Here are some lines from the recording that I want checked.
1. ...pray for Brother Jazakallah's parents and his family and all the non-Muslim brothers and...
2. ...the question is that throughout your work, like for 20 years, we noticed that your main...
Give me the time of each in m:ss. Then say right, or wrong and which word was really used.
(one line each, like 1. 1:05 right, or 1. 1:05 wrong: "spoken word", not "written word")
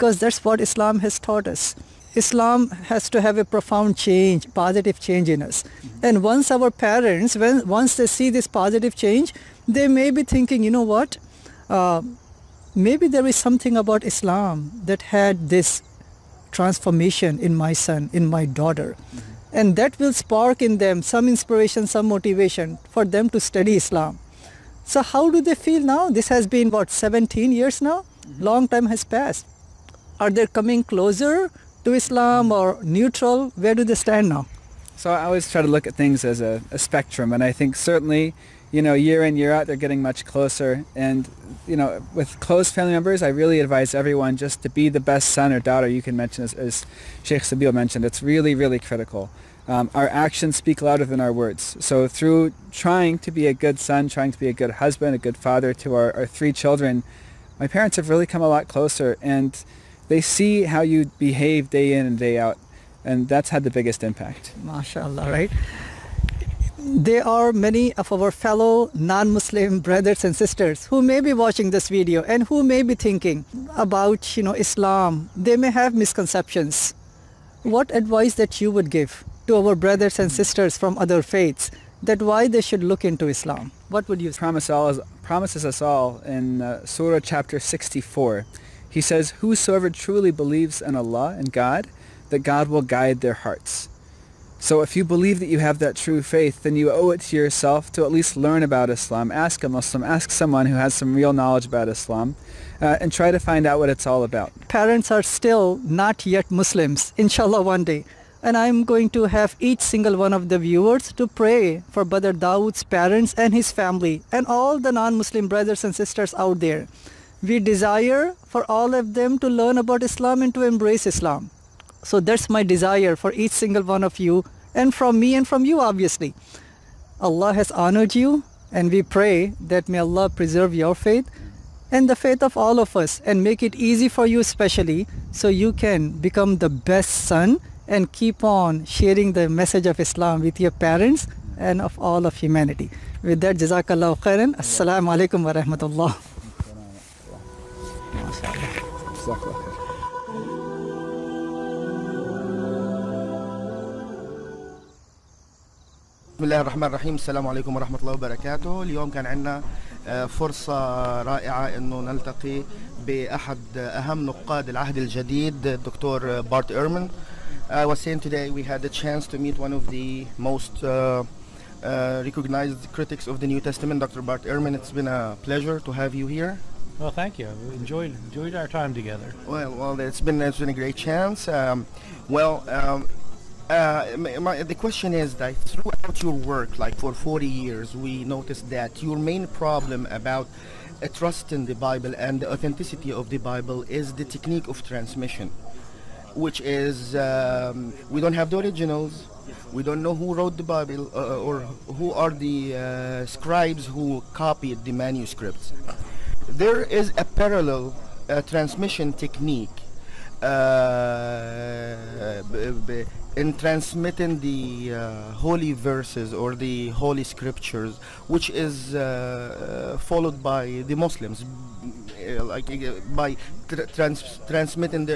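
1. 1:51 wrong: "Dawood", not "Jazakallah"
2. 3:04 wrong: "40", not "20".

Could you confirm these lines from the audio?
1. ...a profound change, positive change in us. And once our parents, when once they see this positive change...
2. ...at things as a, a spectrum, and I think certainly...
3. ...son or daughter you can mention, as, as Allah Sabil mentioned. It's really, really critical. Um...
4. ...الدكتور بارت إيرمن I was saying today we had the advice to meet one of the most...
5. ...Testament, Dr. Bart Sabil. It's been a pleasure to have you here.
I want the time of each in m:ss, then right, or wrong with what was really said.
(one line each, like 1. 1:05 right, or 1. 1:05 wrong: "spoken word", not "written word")
1. 0:03 right
2. 0:35 right
3. 0:45 wrong: "Sheikh", not "Allah"
4. 2:45 wrong: "chance", not "advice"
5. 2:53 wrong: "Ehrman", not "Sabil".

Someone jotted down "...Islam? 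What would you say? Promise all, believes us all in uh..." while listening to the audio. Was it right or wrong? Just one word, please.
wrong.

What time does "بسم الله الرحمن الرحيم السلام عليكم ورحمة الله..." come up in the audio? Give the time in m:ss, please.
2:36.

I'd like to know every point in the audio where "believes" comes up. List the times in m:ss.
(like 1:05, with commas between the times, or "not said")
1:30, 1:35.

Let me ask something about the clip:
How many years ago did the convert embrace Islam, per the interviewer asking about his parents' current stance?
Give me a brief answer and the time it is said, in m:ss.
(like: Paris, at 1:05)
17, at 0:26.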